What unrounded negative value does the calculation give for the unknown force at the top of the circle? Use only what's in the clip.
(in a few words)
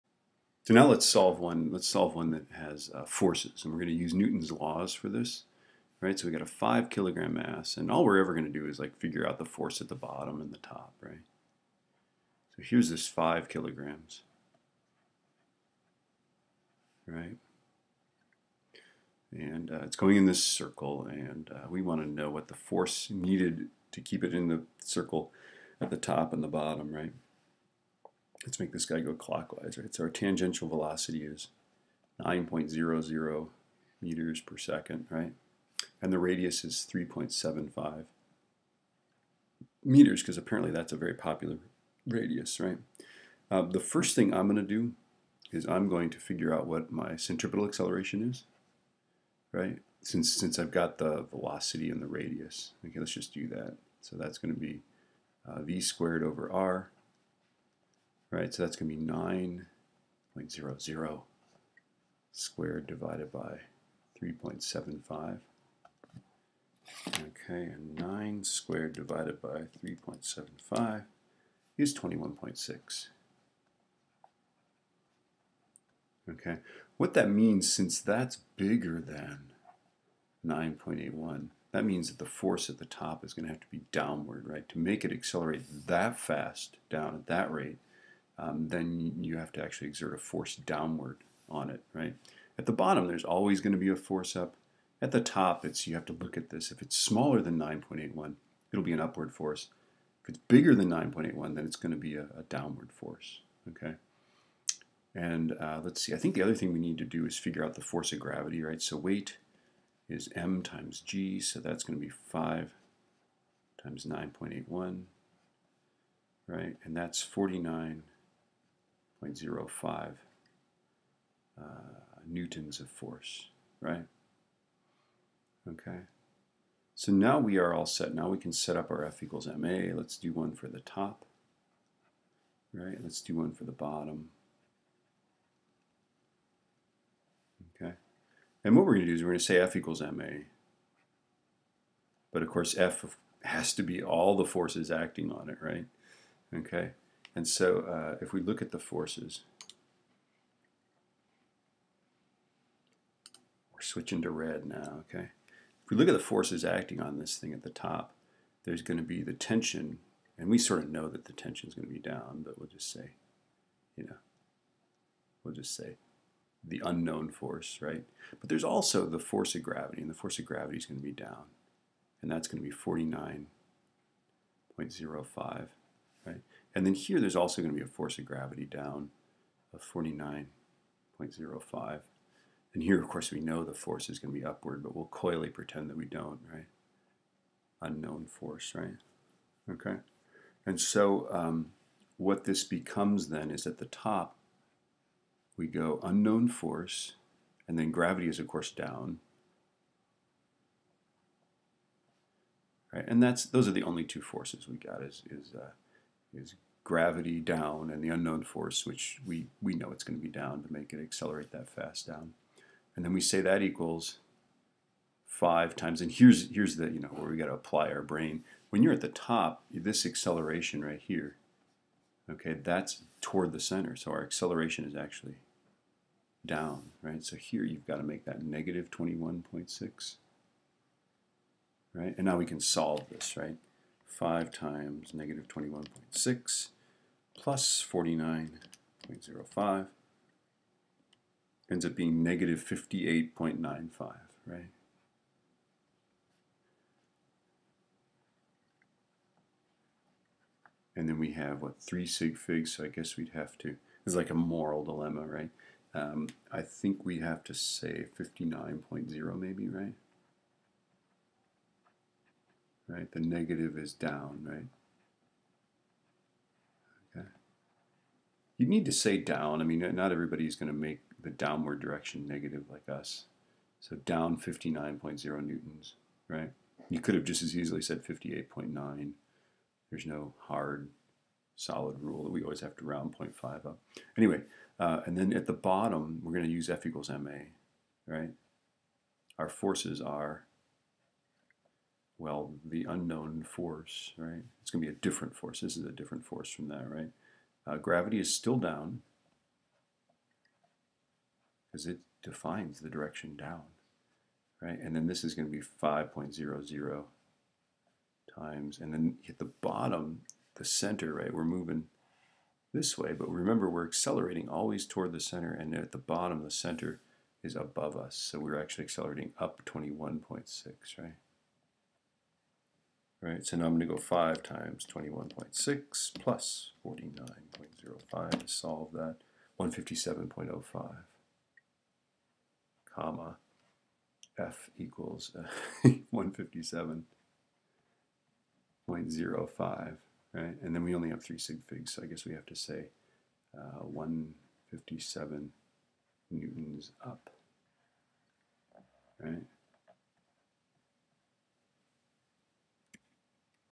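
-58.95.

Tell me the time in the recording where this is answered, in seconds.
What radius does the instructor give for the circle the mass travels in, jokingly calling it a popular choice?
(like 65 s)
36 s.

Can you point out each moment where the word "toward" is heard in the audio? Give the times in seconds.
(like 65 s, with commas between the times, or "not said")
223 s, 314 s.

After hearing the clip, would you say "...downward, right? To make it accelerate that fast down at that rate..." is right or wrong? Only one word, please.
right.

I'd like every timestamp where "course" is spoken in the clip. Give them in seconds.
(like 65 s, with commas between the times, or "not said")
142 s, 183 s, 198 s.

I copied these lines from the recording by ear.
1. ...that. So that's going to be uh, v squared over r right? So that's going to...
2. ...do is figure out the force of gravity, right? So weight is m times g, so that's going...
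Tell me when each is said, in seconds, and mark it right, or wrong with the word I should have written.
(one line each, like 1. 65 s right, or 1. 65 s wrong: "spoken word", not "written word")
1. 53 s right
2. 107 s right.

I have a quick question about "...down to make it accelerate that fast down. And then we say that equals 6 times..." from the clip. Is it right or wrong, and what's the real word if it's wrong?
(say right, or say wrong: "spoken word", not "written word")
wrong: "5", not "6".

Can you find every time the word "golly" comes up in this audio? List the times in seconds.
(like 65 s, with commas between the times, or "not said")
not said.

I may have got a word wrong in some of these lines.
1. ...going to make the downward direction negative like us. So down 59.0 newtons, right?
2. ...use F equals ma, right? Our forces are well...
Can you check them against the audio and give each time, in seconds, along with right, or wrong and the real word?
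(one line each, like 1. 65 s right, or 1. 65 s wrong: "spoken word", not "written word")
1. 270 s right
2. 286 s right.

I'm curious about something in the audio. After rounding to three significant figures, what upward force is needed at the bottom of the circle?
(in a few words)
157 newtons.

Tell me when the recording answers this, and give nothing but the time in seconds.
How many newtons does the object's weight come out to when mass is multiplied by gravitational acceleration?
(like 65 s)
117 s.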